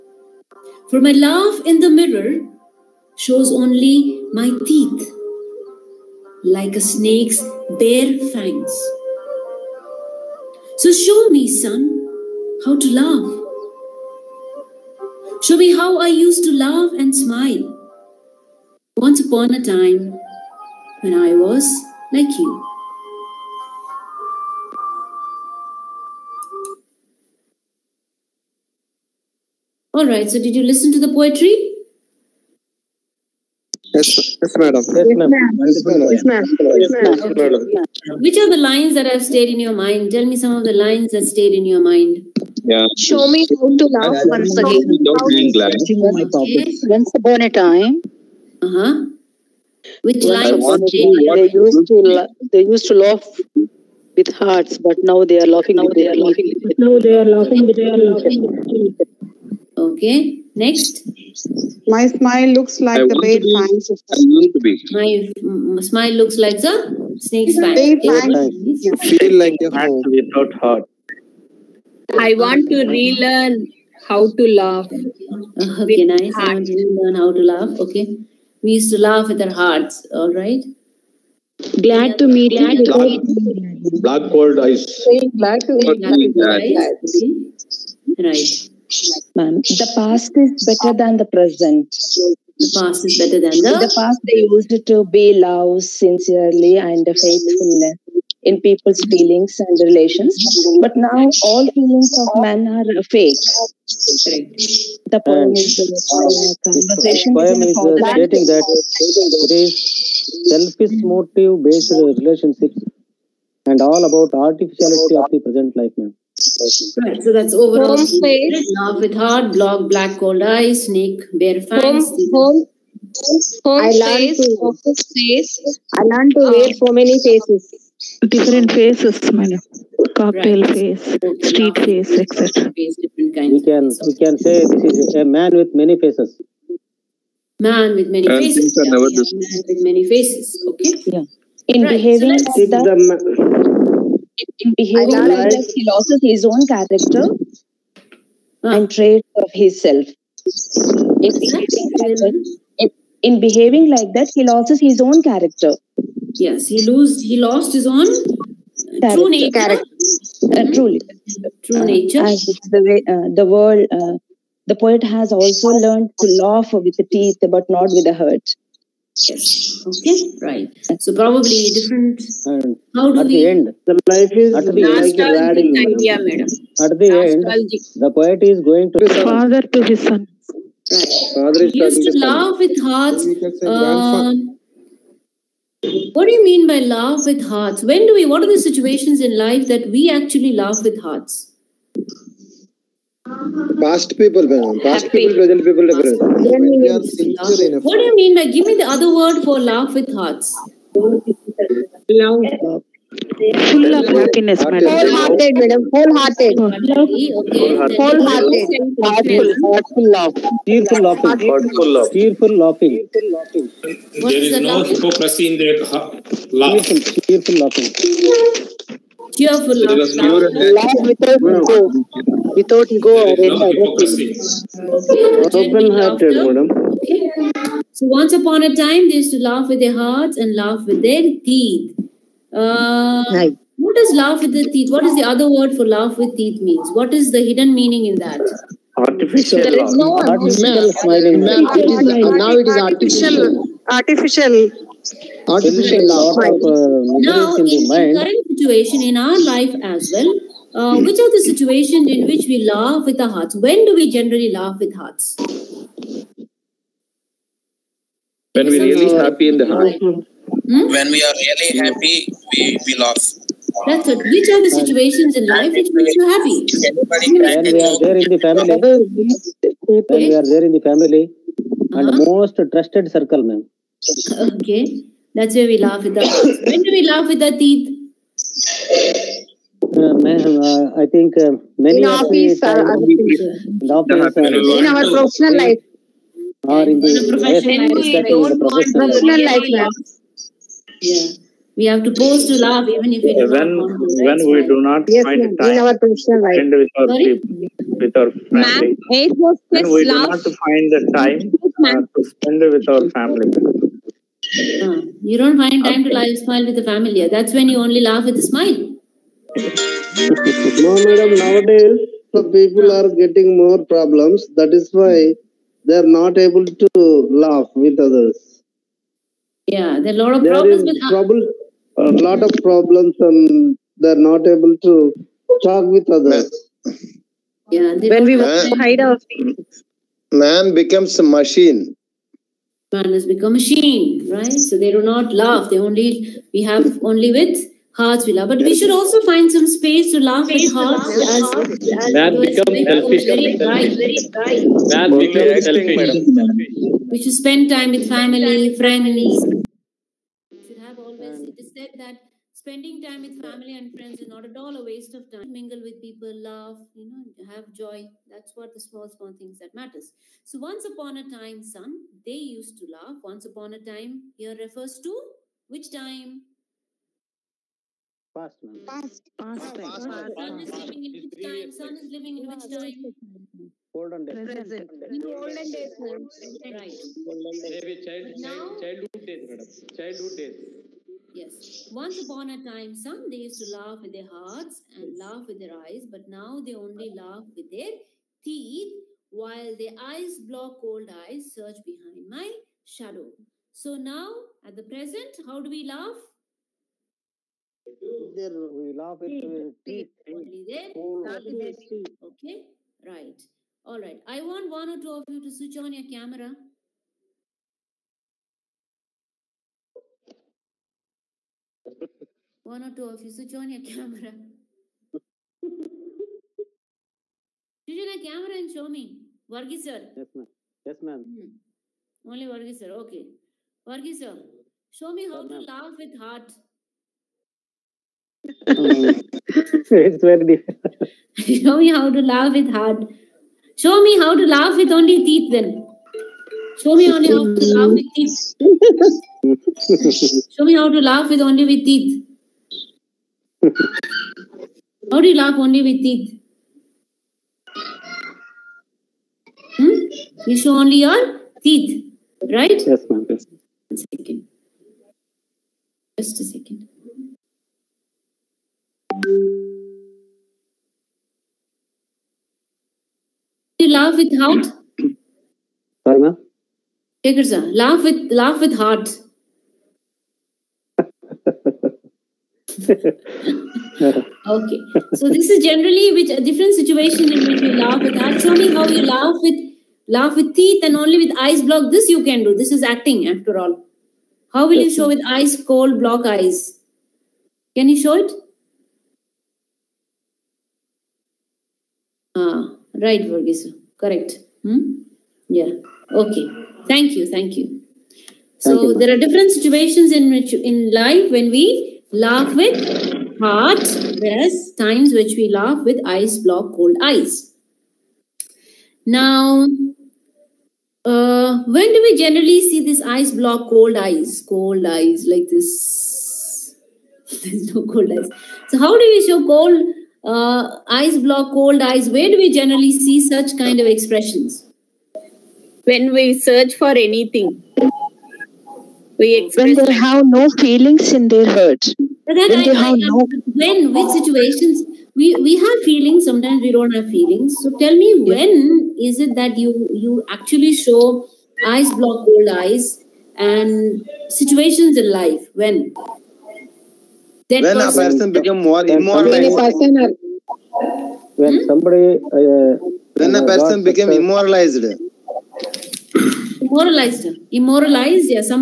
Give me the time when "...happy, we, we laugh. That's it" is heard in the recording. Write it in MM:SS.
04:21.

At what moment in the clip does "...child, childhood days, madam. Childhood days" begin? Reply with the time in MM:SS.
06:18.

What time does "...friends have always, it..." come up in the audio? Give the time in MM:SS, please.
05:48.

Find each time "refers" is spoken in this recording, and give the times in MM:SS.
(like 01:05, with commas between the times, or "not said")
06:04.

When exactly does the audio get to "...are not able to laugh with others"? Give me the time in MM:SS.
05:15.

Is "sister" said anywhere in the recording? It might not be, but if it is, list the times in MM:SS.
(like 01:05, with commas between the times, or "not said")
not said.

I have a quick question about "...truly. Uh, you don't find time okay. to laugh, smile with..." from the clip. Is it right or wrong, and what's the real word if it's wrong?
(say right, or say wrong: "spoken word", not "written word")
wrong: "family", not "truly".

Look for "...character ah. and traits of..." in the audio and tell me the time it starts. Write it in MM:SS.
02:26.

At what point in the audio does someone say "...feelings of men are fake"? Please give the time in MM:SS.
01:41.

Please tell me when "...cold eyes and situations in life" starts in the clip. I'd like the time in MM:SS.
09:02.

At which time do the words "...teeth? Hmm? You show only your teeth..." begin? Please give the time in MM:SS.
07:26.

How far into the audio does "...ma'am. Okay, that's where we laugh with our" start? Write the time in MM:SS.
04:33.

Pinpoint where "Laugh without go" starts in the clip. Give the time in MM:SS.
03:39.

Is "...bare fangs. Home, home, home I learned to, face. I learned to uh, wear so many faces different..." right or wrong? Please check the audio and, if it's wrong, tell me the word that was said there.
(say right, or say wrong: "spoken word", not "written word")
right.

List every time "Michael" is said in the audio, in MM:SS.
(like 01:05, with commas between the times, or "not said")
not said.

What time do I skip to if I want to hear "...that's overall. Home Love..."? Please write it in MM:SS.
01:57.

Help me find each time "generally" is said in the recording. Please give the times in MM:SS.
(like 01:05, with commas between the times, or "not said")
04:14, 07:55, 08:32, 08:42.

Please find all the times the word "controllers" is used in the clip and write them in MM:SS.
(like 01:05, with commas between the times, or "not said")
not said.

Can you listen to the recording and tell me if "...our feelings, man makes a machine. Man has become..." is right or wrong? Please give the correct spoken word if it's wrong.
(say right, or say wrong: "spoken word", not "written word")
wrong: "becomes", not "makes".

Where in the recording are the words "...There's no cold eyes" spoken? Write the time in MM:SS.
08:37.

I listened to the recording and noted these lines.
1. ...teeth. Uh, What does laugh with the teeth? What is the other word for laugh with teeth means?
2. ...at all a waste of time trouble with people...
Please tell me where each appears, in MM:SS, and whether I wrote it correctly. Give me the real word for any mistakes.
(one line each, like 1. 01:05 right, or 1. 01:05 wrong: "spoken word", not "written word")
1. 03:51 right
2. 05:54 wrong: "mingle", not "trouble".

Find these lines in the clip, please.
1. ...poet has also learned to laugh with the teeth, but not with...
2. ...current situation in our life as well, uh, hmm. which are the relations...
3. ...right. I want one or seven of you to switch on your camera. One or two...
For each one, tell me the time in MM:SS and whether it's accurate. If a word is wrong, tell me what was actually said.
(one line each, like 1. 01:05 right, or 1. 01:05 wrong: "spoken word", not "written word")
1. 02:44 right
2. 04:08 wrong: "situations", not "relations"
3. 06:44 wrong: "two", not "seven".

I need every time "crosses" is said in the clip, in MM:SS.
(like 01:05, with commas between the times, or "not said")
not said.